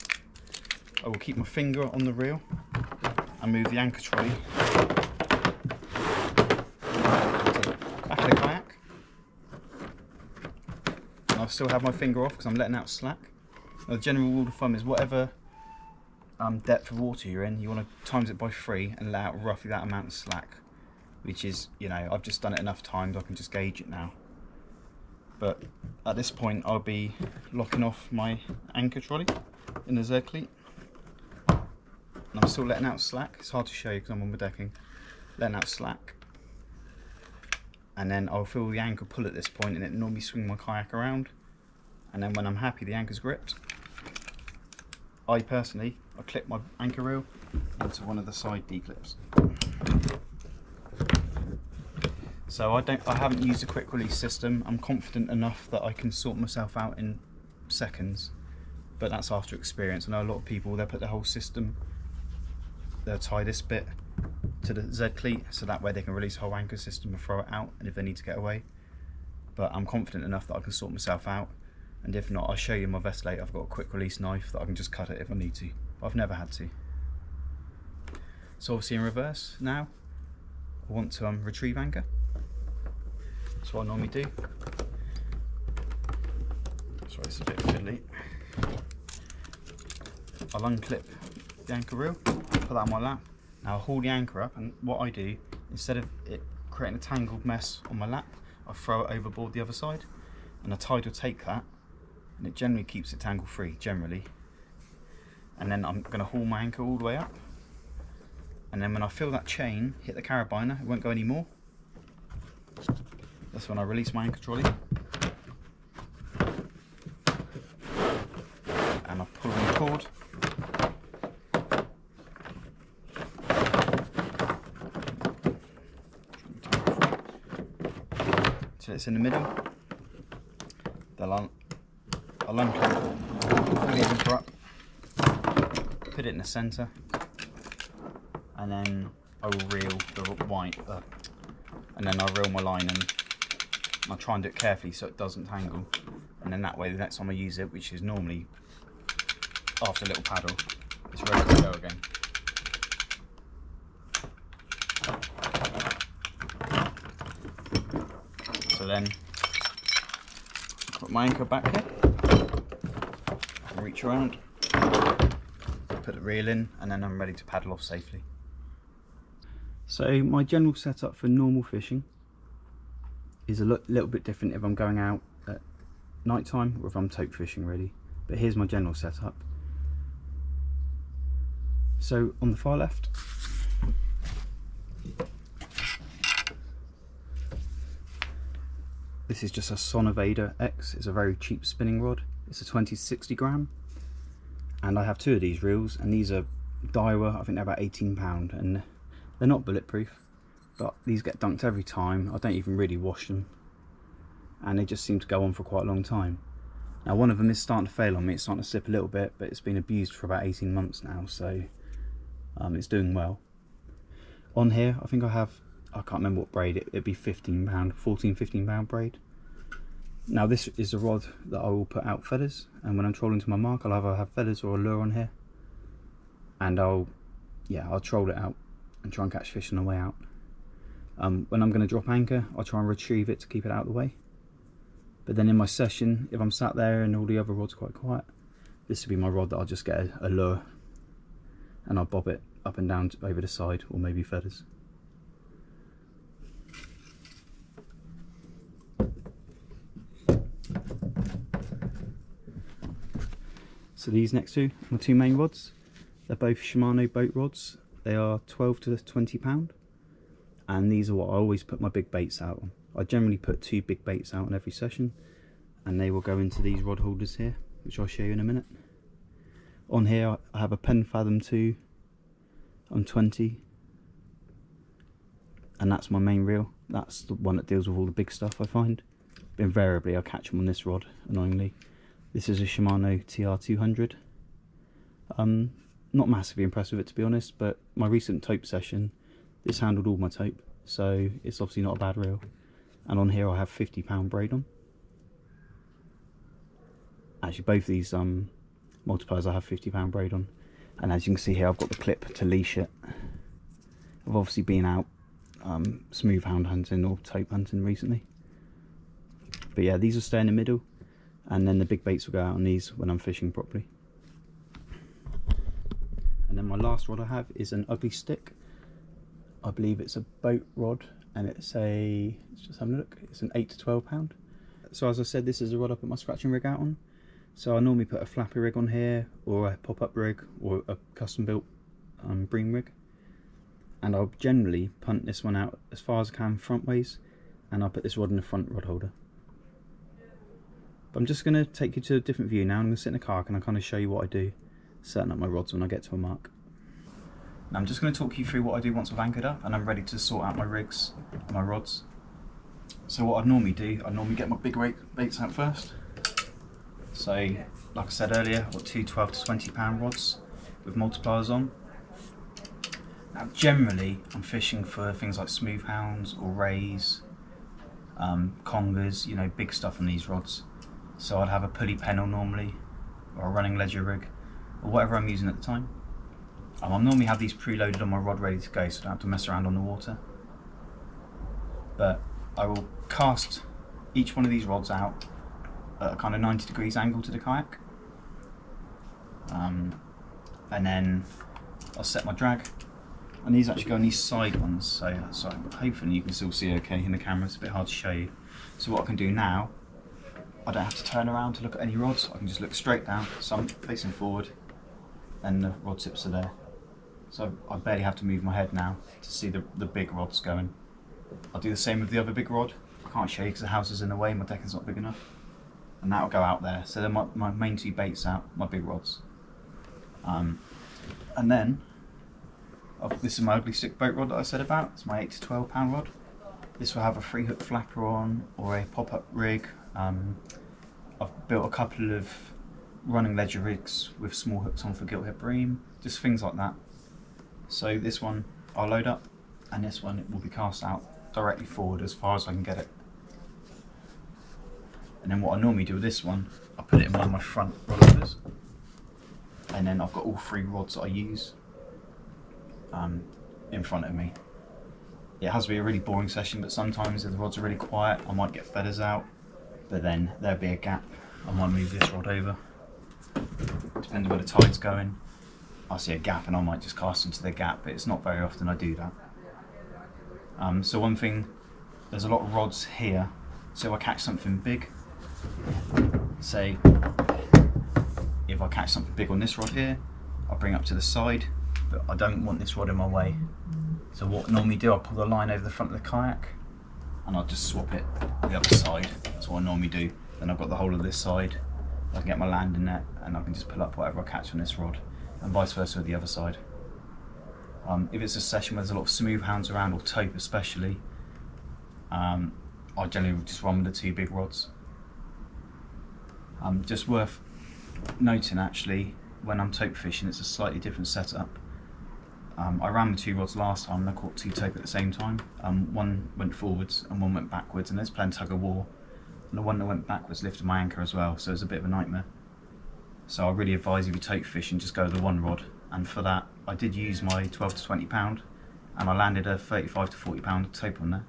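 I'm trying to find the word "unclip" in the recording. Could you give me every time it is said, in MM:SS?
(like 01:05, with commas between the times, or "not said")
01:30, 02:12.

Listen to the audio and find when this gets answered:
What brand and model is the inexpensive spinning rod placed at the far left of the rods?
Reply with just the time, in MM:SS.
03:09.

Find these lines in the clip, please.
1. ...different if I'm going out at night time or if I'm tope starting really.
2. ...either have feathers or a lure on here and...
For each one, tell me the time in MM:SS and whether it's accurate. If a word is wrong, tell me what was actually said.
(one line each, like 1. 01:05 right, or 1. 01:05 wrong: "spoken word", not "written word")
1. 02:54 wrong: "fishing", not "starting"
2. 03:43 right.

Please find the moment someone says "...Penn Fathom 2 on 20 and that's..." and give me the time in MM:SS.
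04:30.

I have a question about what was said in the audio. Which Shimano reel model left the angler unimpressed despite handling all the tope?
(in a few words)
Shimano TR200.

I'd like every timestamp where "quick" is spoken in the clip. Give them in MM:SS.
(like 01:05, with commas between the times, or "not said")
00:53, 01:13.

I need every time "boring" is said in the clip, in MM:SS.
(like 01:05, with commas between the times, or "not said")
07:35.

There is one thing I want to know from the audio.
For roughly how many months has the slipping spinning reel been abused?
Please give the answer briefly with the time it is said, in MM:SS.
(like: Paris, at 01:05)
18 months, at 03:30.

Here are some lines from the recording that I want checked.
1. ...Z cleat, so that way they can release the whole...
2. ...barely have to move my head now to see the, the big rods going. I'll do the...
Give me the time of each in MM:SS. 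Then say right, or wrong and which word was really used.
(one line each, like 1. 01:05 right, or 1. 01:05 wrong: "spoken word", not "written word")
1. 01:04 right
2. 06:47 right.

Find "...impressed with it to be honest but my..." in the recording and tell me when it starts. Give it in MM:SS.
04:46.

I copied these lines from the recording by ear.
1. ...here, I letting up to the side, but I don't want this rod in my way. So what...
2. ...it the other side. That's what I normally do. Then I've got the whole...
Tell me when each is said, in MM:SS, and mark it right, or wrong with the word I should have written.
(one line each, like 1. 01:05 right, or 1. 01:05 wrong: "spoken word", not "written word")
1. 07:59 wrong: "bring", not "letting"
2. 08:07 right.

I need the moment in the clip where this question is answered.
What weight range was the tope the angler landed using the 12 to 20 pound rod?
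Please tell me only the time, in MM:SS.
08:49.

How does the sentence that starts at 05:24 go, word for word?
So as I said, this is a rod I put my scratching rig out on.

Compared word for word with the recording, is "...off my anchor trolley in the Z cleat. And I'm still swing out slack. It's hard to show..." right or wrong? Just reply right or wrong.
wrong.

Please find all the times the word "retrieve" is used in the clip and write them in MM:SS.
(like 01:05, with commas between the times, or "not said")
01:21, 03:52.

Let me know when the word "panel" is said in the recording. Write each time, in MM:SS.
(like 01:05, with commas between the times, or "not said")
06:11.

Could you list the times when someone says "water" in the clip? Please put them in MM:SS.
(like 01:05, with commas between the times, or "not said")
00:16, 06:19.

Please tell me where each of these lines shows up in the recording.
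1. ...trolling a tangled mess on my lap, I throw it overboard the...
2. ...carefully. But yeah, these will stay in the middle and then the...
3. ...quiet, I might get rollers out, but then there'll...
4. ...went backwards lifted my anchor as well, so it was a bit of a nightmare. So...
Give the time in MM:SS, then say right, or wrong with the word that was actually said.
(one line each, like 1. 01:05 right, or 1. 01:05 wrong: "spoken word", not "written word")
1. 01:36 wrong: "creating", not "trolling"
2. 05:07 wrong: "recently", not "carefully"
3. 07:37 wrong: "feathers", not "rollers"
4. 08:39 right.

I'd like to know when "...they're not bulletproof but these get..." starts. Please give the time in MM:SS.
03:19.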